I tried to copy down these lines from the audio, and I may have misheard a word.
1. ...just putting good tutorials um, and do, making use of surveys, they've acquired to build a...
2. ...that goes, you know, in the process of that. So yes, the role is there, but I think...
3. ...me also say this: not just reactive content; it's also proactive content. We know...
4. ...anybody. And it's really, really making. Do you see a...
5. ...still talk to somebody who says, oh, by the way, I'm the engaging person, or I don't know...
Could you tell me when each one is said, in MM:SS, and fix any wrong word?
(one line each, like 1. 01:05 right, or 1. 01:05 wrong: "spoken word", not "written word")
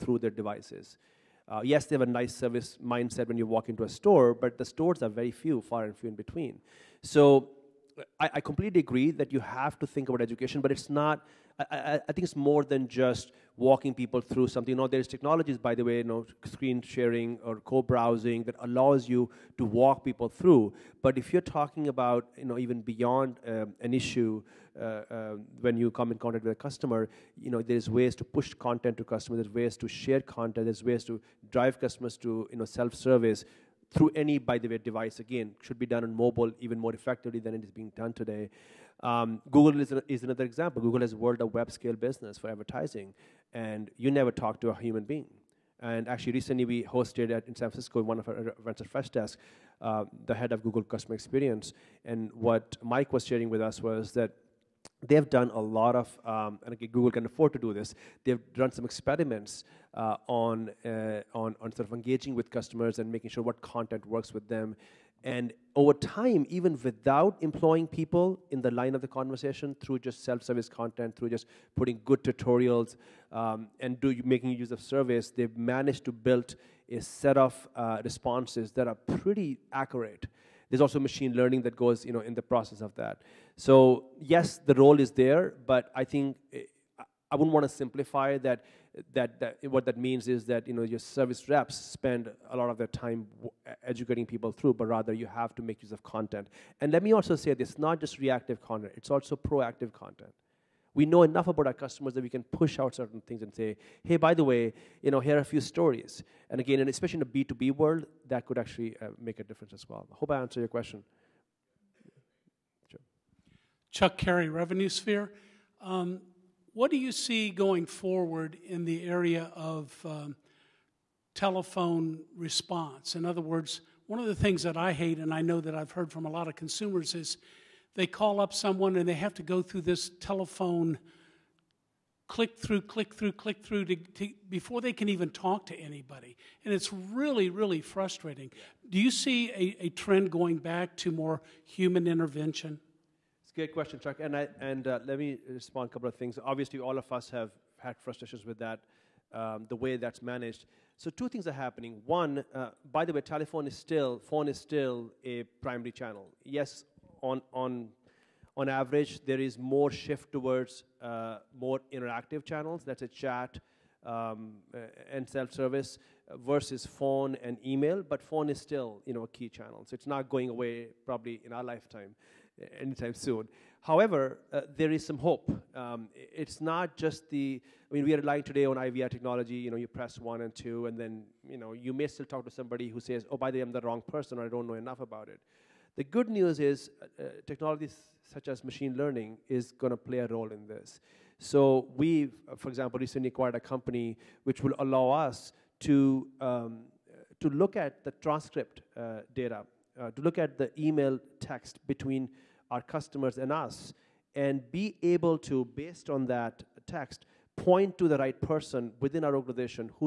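1. 01:11 wrong: "managed", not "acquired"
2. 01:21 right
3. 01:37 right
4. 02:15 wrong: "frustrating", not "making"
5. 03:02 wrong: "wrong", not "engaging".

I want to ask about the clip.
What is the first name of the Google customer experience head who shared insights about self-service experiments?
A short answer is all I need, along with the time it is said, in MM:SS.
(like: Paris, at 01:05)
Mike, at 00:52.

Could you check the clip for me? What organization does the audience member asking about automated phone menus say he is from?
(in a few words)
Revenue Sphere.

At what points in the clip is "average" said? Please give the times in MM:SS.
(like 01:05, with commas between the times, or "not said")
02:38.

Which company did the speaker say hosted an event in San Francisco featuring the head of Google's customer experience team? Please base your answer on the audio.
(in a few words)
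Freshdesk.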